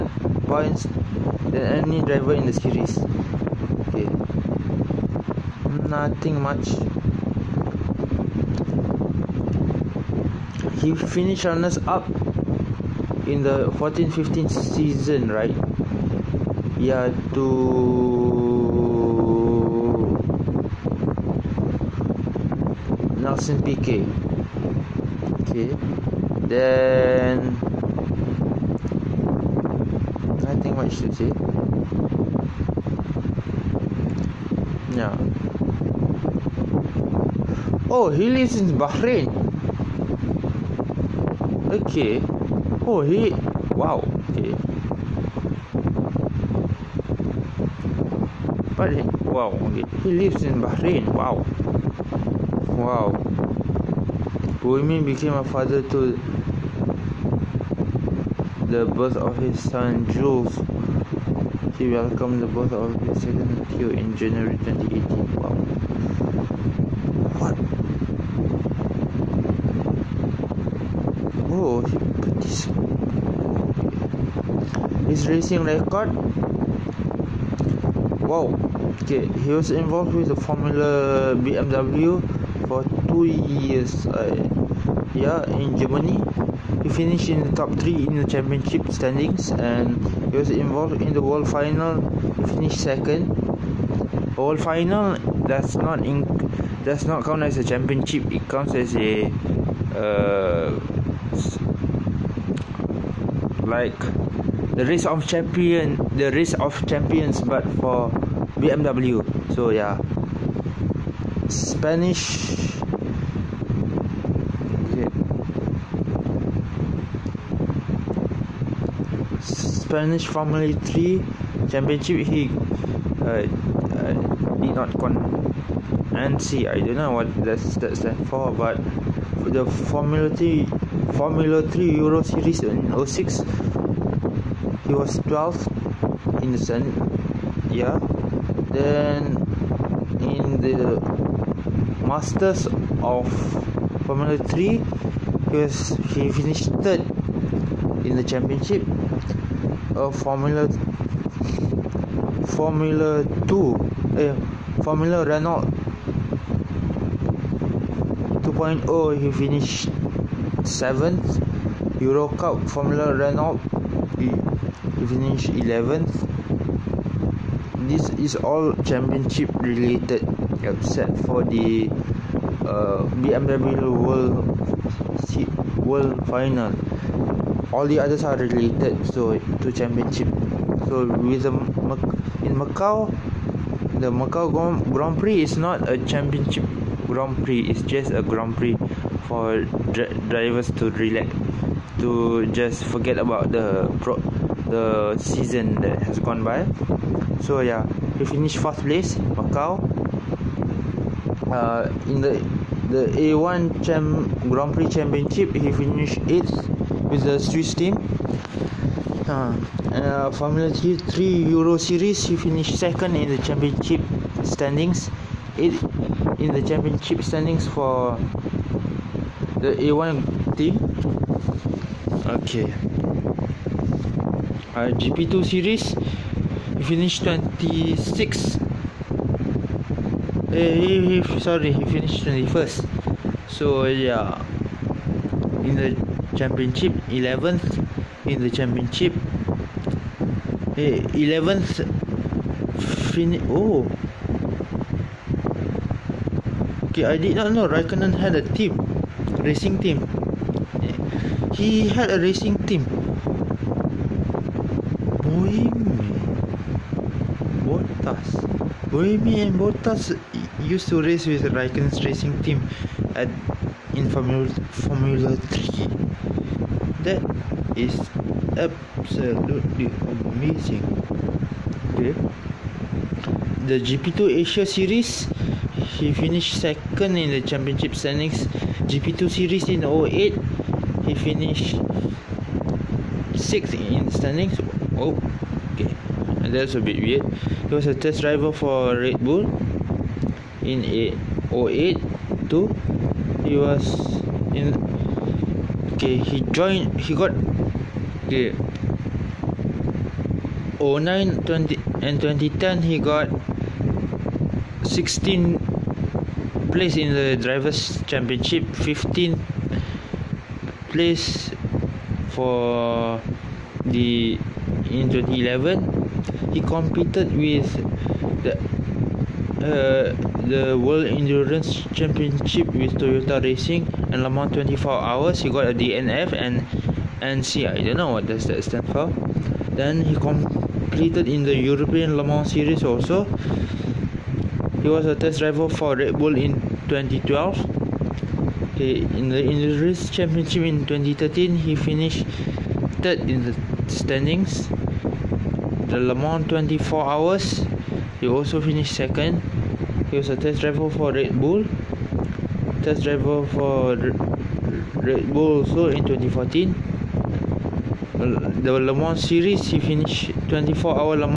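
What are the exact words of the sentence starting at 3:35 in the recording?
It in the championship standings for the A1 team.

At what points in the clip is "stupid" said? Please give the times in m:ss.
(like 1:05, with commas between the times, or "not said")
not said.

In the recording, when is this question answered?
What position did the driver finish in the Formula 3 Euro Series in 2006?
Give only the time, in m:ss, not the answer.
2:15.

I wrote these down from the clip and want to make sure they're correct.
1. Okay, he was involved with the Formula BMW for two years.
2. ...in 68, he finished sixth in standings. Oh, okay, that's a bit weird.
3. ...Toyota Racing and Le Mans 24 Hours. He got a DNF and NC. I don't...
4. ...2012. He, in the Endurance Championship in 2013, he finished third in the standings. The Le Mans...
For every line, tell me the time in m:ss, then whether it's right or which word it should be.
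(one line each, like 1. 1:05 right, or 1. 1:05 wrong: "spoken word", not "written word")
1. 1:19 right
2. 4:39 wrong: "08", not "68"
3. 5:22 right
4. 5:36 right.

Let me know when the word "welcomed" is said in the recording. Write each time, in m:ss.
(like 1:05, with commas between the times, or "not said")
1:01.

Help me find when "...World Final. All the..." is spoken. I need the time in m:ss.
2:55.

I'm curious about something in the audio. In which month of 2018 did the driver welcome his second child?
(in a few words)
January.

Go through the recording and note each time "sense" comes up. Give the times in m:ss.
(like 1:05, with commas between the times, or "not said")
not said.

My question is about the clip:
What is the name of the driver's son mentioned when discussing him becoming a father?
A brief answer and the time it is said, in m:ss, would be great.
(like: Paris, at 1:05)
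Jules, at 1:00.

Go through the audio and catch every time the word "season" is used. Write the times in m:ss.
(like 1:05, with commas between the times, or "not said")
0:14, 3:15.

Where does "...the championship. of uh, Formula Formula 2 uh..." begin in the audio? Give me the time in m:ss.
2:28.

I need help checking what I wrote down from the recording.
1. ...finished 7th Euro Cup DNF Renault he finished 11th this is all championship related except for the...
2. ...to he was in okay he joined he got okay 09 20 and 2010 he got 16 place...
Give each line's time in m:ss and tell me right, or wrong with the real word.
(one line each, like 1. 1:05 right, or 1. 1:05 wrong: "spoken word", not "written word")
1. 2:39 wrong: "Formula", not "DNF"
2. 4:52 right.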